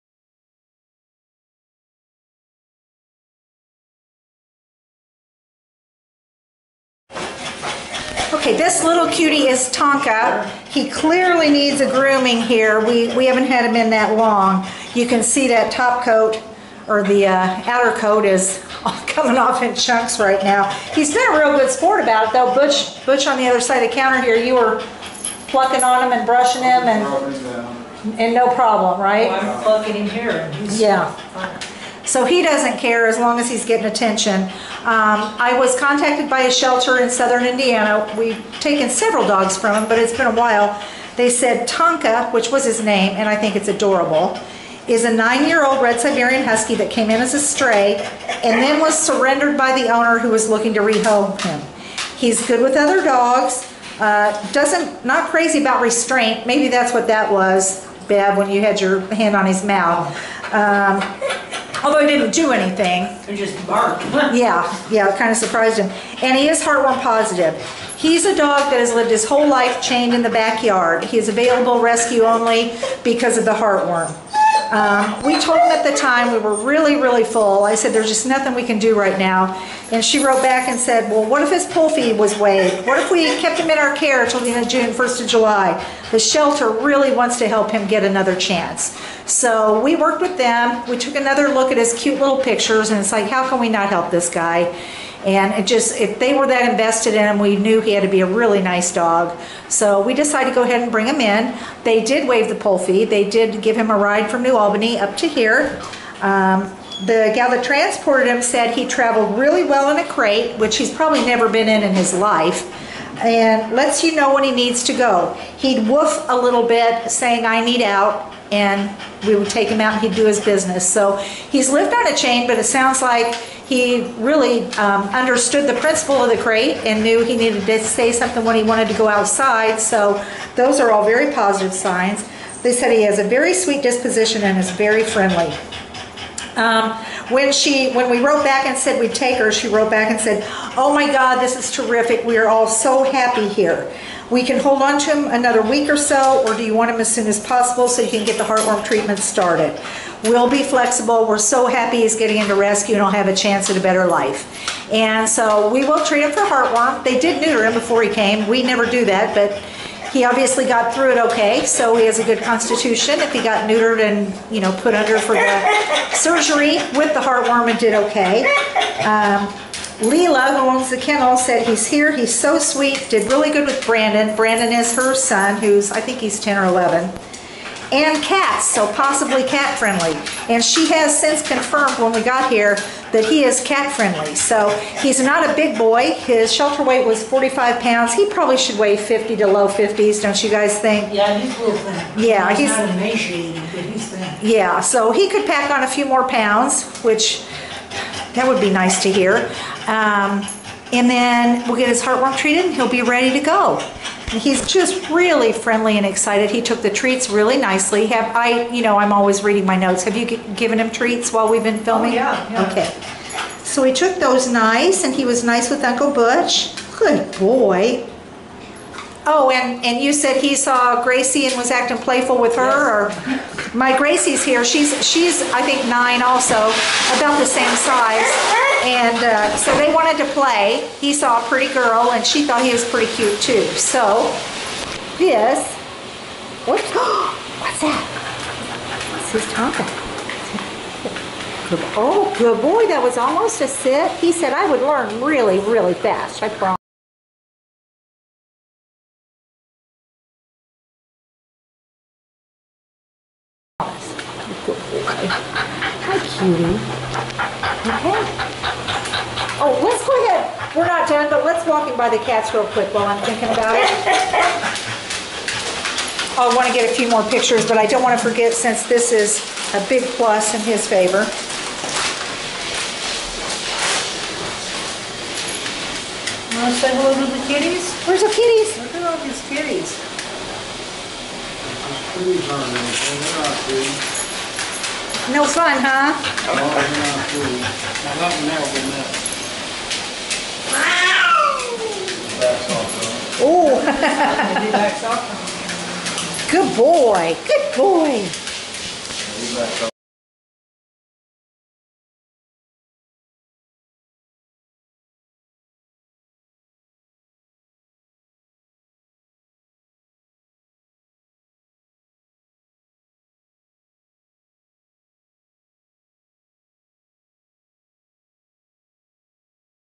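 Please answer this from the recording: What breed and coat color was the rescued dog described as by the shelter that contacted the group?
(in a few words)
Red Siberian Husky.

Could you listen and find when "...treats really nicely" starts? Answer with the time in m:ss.
3:26.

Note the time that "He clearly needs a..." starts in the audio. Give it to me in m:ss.
0:10.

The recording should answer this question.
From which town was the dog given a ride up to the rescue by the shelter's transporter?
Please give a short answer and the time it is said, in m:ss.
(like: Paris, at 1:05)
New Albany, at 1:44.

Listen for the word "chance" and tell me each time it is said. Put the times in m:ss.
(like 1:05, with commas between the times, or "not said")
1:28, 2:33.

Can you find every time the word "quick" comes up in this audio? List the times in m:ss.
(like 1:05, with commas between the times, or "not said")
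4:22.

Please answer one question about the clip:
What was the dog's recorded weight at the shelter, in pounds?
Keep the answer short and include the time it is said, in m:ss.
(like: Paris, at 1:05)
45, at 3:07.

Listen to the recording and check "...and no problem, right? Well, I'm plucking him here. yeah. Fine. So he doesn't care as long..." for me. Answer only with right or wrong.
right.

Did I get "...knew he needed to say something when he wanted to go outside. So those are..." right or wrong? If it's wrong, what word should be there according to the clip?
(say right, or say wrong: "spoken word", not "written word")
right.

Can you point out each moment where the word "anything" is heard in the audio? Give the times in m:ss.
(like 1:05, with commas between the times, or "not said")
1:02, 4:42.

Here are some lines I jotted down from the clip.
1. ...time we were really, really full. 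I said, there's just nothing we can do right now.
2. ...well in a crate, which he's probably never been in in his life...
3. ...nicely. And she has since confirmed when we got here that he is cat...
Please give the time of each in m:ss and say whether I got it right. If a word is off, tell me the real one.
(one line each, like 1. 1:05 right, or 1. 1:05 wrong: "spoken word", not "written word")
1. 1:15 right
2. 1:49 right
3. 2:59 wrong: "friendly", not "nicely".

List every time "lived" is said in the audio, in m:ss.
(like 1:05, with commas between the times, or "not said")
1:08, 2:01.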